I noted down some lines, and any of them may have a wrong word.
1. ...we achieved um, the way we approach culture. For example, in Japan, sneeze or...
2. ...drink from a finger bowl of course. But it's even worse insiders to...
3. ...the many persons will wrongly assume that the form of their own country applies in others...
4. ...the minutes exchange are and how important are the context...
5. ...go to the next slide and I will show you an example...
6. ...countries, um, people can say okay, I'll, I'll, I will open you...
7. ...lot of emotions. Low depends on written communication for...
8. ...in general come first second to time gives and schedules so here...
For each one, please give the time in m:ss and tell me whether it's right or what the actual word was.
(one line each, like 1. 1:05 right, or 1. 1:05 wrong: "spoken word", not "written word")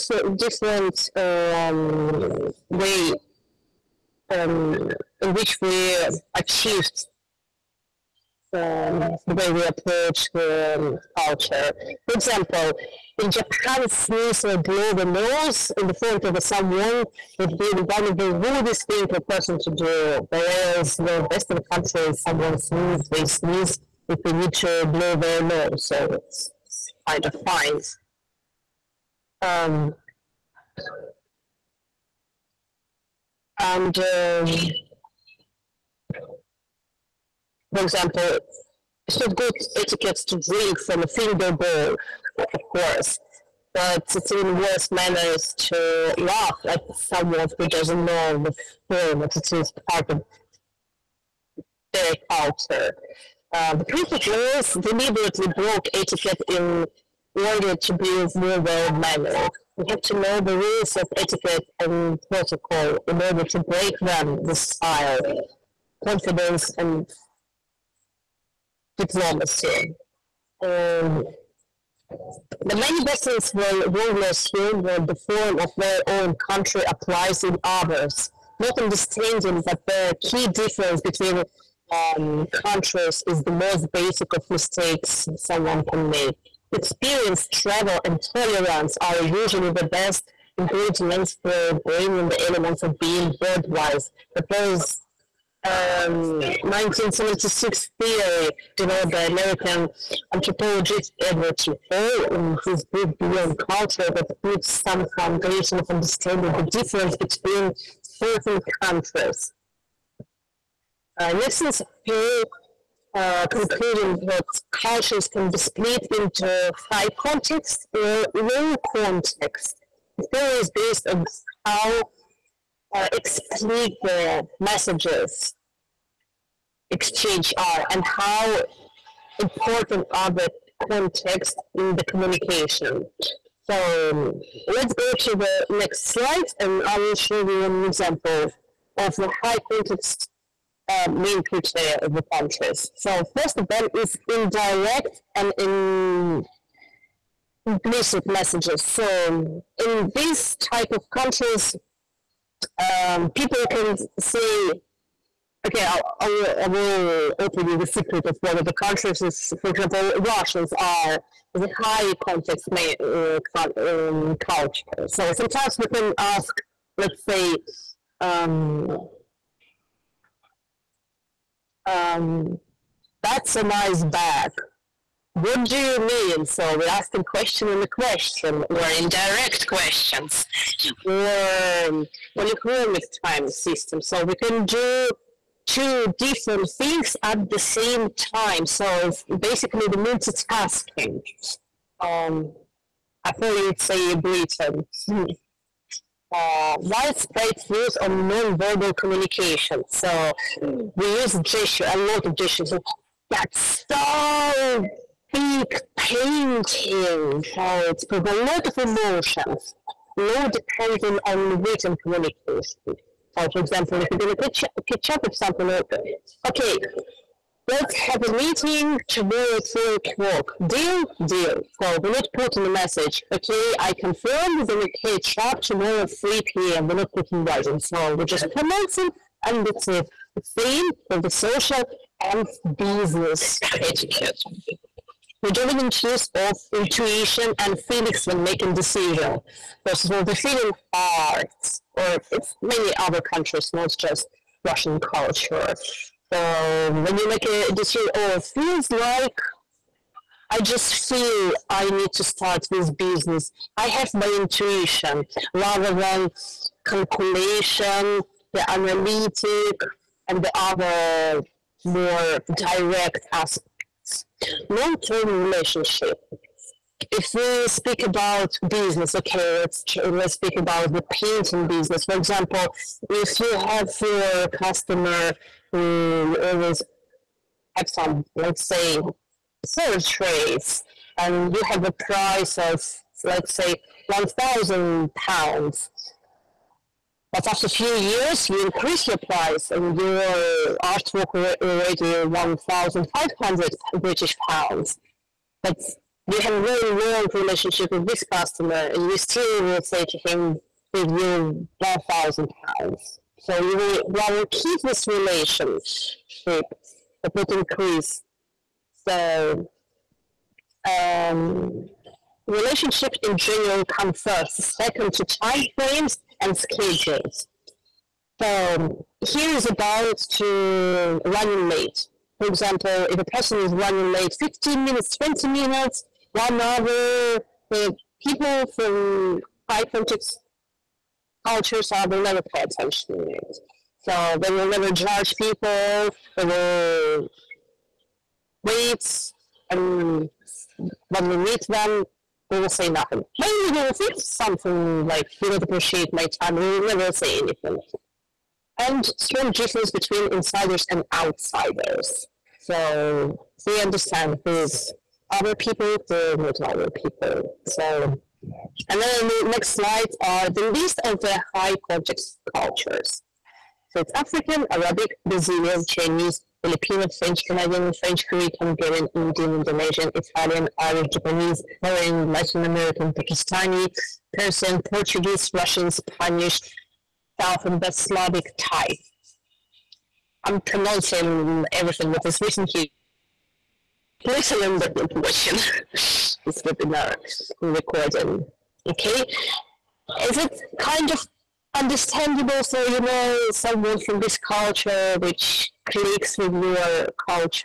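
1. 0:05 right
2. 0:40 wrong: "manners", not "insiders"
3. 1:12 right
4. 2:04 wrong: "messages", not "minutes"
5. 2:14 right
6. 2:31 right
7. 3:28 right
8. 5:13 wrong: "frames", not "gives".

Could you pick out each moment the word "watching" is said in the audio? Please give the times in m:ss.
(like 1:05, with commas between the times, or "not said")
6:25.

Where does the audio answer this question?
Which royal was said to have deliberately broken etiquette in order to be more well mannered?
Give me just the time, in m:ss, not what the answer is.
0:53.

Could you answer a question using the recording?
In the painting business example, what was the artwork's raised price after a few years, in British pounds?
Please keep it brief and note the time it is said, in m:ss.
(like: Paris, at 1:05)
1500, at 4:52.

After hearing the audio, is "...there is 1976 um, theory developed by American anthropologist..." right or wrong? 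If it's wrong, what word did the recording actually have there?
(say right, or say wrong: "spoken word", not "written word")
right.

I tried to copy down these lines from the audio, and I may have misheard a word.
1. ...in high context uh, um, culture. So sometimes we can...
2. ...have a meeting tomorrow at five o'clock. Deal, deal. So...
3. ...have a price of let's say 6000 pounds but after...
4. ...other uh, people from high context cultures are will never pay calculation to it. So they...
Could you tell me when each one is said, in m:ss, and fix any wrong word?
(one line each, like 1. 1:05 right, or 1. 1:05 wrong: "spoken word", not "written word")
1. 2:41 right
2. 3:37 wrong: "three", not "five"
3. 4:41 wrong: "1000", not "6000"
4. 5:26 wrong: "attention", not "calculation".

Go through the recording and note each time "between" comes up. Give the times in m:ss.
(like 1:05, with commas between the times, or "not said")
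1:21, 1:47, 5:49.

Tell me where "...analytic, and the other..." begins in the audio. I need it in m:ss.
4:18.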